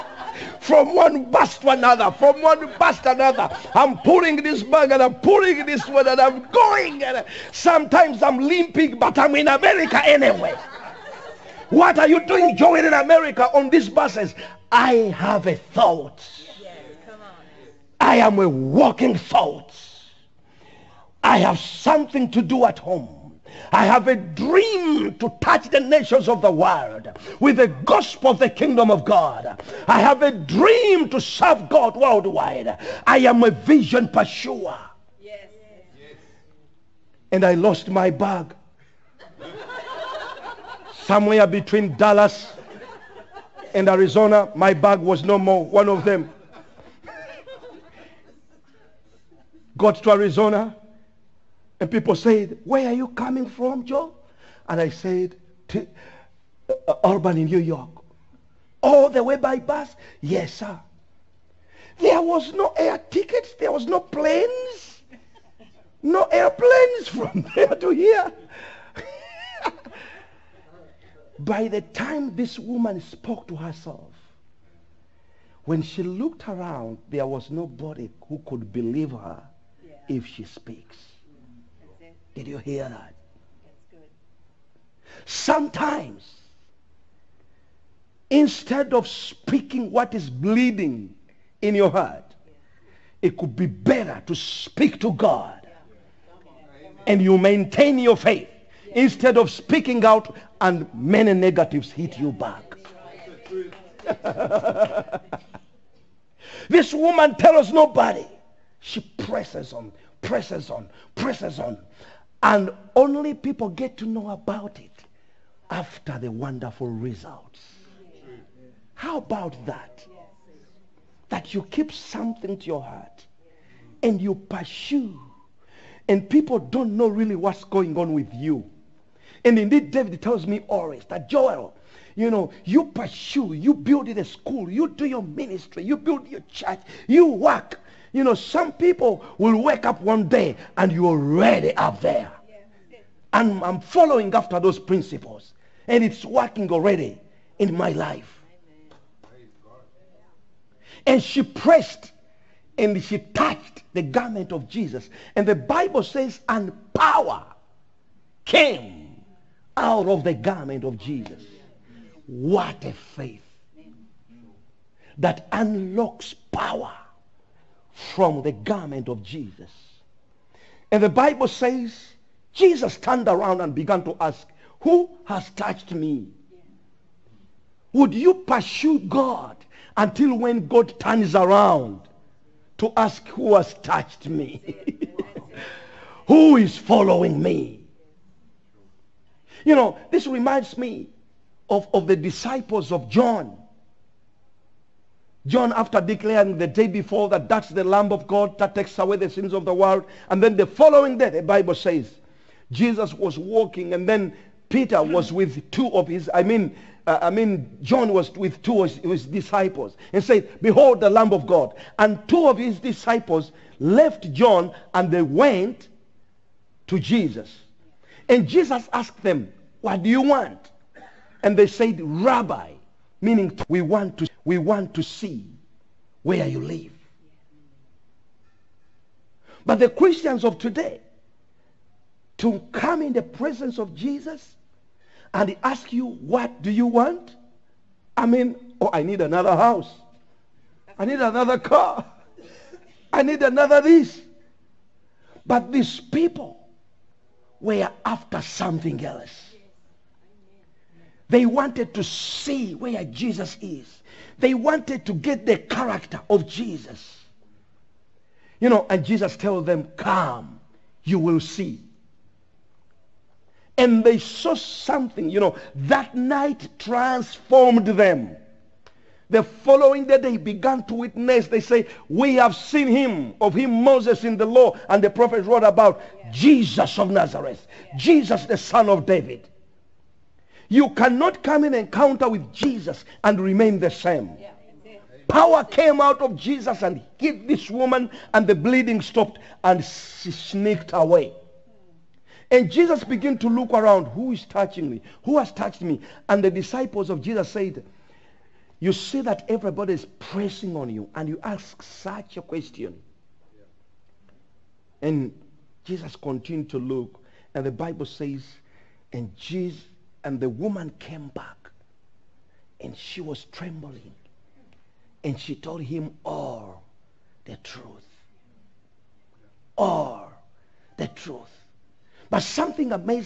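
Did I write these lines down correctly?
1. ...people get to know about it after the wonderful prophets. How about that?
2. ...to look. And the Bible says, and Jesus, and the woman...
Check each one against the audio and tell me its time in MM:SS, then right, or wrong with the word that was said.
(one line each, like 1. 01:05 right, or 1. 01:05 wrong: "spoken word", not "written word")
1. 01:53 wrong: "results", not "prophets"
2. 05:06 right.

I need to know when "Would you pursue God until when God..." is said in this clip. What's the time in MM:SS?
02:57.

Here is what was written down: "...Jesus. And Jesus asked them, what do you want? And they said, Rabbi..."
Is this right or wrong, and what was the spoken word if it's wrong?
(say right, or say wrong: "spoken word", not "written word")
right.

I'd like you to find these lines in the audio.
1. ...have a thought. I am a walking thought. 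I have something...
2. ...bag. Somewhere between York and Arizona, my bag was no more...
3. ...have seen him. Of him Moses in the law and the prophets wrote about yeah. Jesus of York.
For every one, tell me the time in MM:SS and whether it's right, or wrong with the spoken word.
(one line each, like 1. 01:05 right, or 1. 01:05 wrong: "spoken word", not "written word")
1. 00:15 right
2. 00:38 wrong: "Dallas", not "York"
3. 04:32 wrong: "Nazareth", not "York".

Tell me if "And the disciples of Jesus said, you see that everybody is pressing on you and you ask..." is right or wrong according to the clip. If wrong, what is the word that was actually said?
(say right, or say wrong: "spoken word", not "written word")
right.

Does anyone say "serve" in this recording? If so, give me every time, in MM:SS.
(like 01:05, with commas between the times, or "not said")
00:31.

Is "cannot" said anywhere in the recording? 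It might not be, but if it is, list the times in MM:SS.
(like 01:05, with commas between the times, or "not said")
04:40.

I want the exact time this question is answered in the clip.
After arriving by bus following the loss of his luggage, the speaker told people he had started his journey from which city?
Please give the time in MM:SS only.
00:57.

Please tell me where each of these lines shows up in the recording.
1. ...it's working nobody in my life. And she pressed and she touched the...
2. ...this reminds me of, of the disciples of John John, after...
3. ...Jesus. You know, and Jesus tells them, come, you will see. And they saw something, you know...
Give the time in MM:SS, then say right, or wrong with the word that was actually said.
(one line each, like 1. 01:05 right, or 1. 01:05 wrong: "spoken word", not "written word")
1. 02:26 wrong: "already", not "nobody"
2. 03:10 right
3. 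04:16 right.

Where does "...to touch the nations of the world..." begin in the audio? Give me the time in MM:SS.
00:25.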